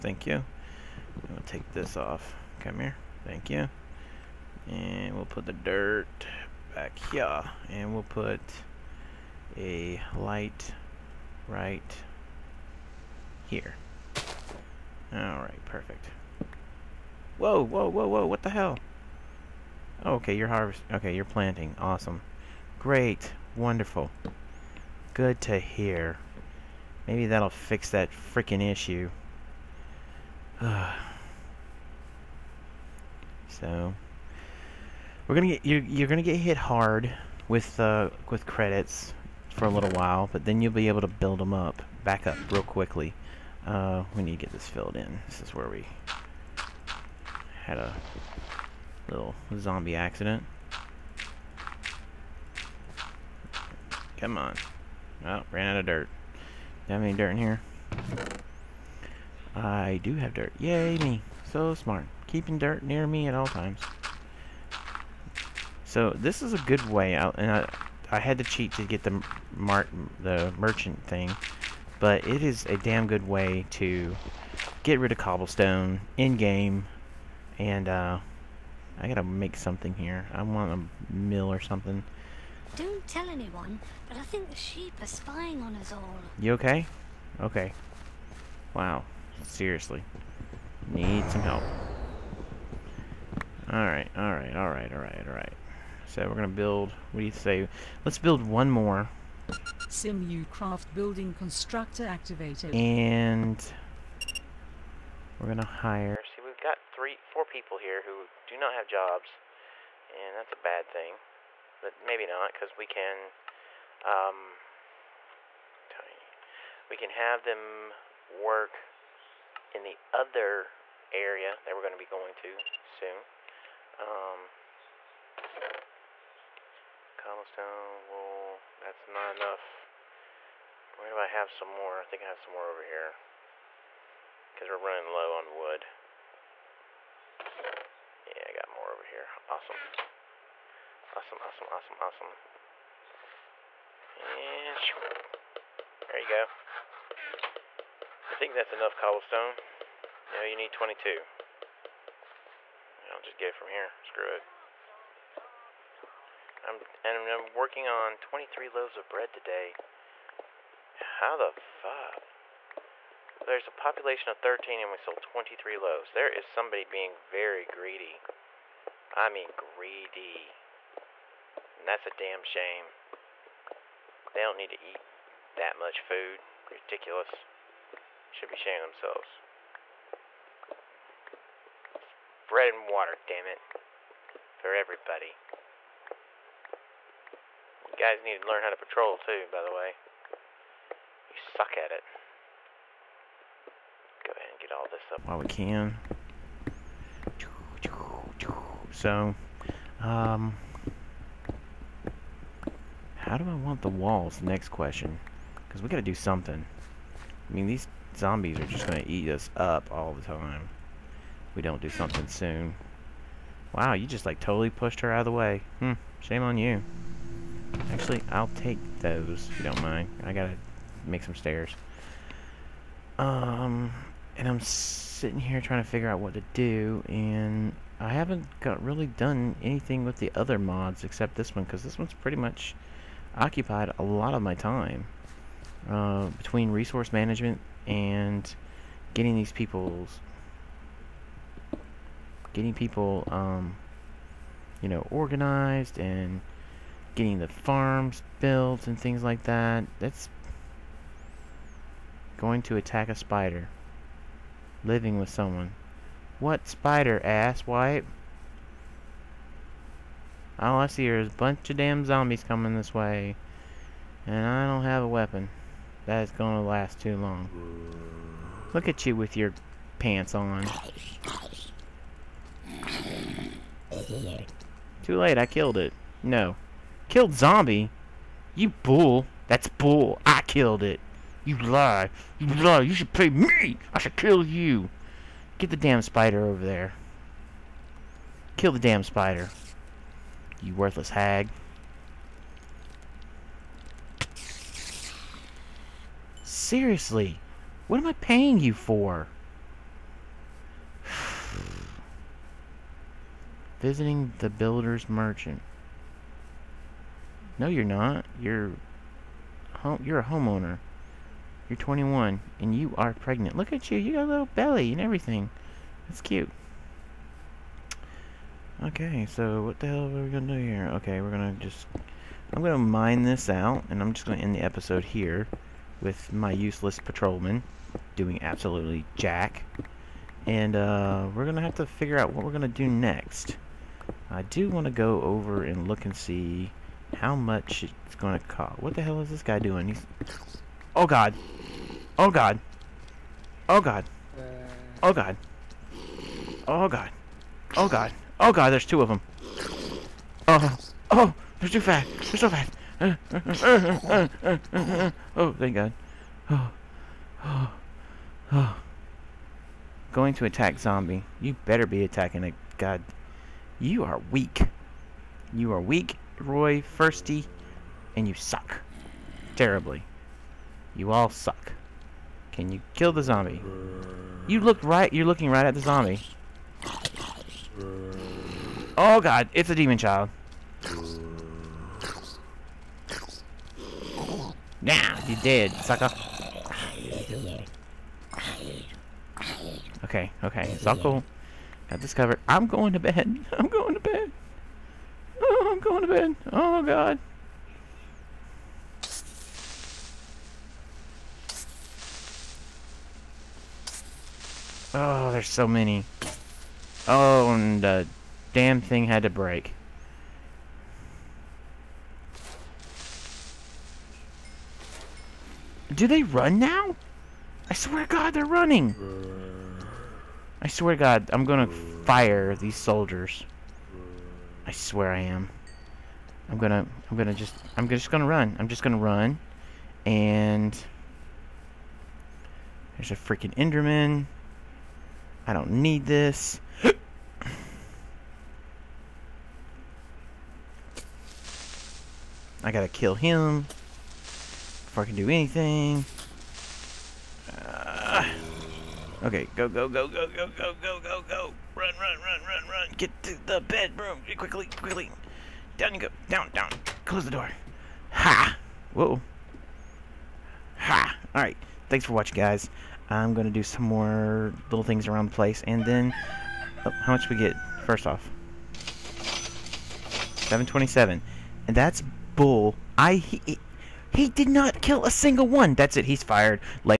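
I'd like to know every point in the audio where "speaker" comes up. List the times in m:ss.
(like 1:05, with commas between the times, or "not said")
not said.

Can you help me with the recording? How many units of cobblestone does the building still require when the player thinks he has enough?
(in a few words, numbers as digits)
22.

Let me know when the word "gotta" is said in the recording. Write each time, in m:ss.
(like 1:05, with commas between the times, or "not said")
1:19, 3:40, 7:22.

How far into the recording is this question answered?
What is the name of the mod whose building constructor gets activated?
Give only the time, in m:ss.
1:39.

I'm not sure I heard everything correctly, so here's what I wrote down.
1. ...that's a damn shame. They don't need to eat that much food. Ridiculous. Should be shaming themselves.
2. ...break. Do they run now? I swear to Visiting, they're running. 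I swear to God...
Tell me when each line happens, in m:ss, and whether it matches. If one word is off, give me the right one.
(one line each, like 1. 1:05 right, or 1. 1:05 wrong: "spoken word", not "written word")
1. 2:51 right
2. 6:49 wrong: "God", not "Visiting".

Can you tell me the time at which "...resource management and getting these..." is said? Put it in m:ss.
3:56.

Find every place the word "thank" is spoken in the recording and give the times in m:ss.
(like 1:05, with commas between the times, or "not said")
0:03, 5:55, 7:41.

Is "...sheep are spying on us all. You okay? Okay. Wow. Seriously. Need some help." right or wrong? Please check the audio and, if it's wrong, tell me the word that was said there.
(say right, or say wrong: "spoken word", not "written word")
right.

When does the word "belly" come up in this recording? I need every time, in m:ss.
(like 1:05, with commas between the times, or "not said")
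5:14.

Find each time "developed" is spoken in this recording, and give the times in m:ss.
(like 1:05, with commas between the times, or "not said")
not said.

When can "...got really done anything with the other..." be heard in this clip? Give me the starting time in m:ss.
3:48.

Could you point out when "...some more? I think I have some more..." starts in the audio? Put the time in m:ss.
2:11.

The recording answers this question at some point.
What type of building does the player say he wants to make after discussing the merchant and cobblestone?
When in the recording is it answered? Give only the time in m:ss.
1:21.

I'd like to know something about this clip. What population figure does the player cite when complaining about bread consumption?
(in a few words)
13.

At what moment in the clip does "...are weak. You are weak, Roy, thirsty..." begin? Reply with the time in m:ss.
6:04.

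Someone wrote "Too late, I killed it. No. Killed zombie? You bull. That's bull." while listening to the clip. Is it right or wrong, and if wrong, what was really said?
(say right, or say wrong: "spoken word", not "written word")
right.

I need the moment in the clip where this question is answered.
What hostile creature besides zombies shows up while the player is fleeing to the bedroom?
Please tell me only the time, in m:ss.
7:13.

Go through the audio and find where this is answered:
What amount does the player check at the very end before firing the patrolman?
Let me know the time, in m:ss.
7:48.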